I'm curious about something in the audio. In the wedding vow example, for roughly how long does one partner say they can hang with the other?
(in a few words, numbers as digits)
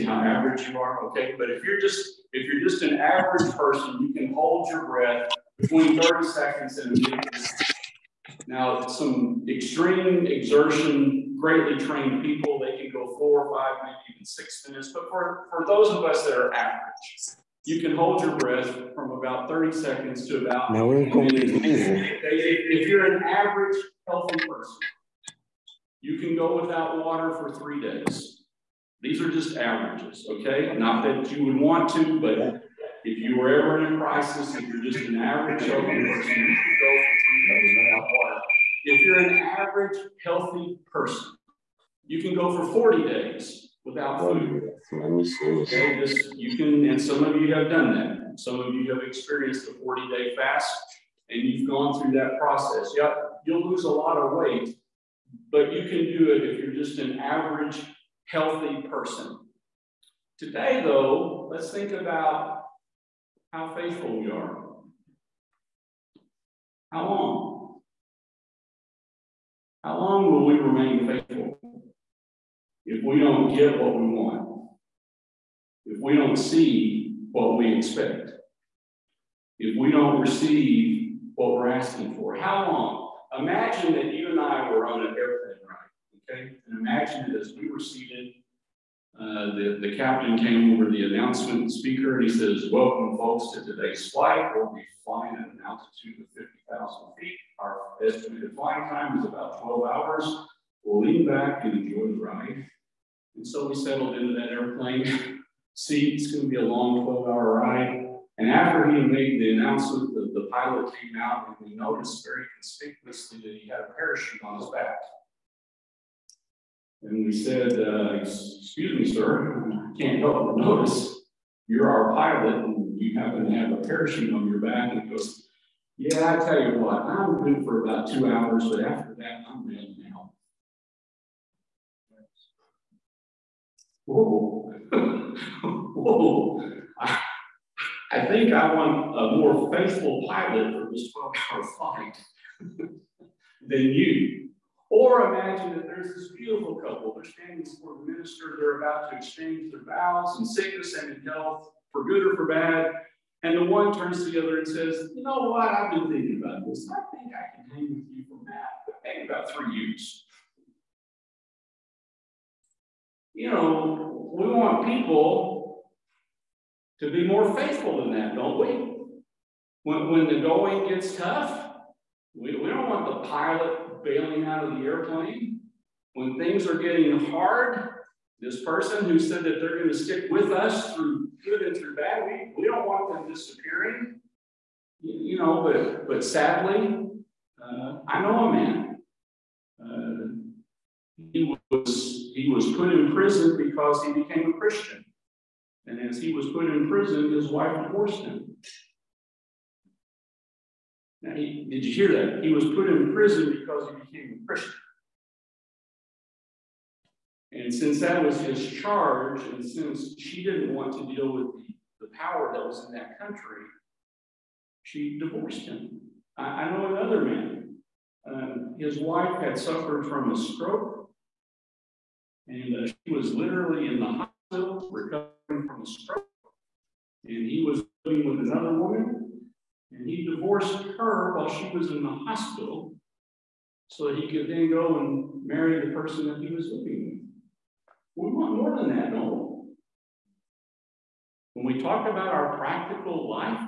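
3 years.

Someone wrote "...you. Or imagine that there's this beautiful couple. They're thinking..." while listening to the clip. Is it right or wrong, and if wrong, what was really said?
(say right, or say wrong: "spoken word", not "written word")
wrong: "standing", not "thinking".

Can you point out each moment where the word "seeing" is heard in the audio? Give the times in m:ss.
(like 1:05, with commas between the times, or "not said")
not said.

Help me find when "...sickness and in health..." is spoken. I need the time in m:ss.
2:30.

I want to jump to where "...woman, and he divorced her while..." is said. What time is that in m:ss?
3:48.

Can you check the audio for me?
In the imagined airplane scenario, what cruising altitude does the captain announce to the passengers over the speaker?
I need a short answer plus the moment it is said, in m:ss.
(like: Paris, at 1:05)
50,000 feet, at 1:36.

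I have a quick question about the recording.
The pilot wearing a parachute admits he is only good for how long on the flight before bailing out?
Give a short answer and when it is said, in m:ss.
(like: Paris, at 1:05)
2 hours, at 2:08.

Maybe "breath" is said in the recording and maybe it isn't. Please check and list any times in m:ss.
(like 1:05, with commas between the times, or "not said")
0:04, 0:18.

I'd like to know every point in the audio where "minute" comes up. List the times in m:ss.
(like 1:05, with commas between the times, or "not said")
0:07, 0:14.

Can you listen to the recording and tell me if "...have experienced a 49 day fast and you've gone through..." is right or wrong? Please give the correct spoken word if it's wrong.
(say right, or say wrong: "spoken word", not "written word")
wrong: "40", not "49".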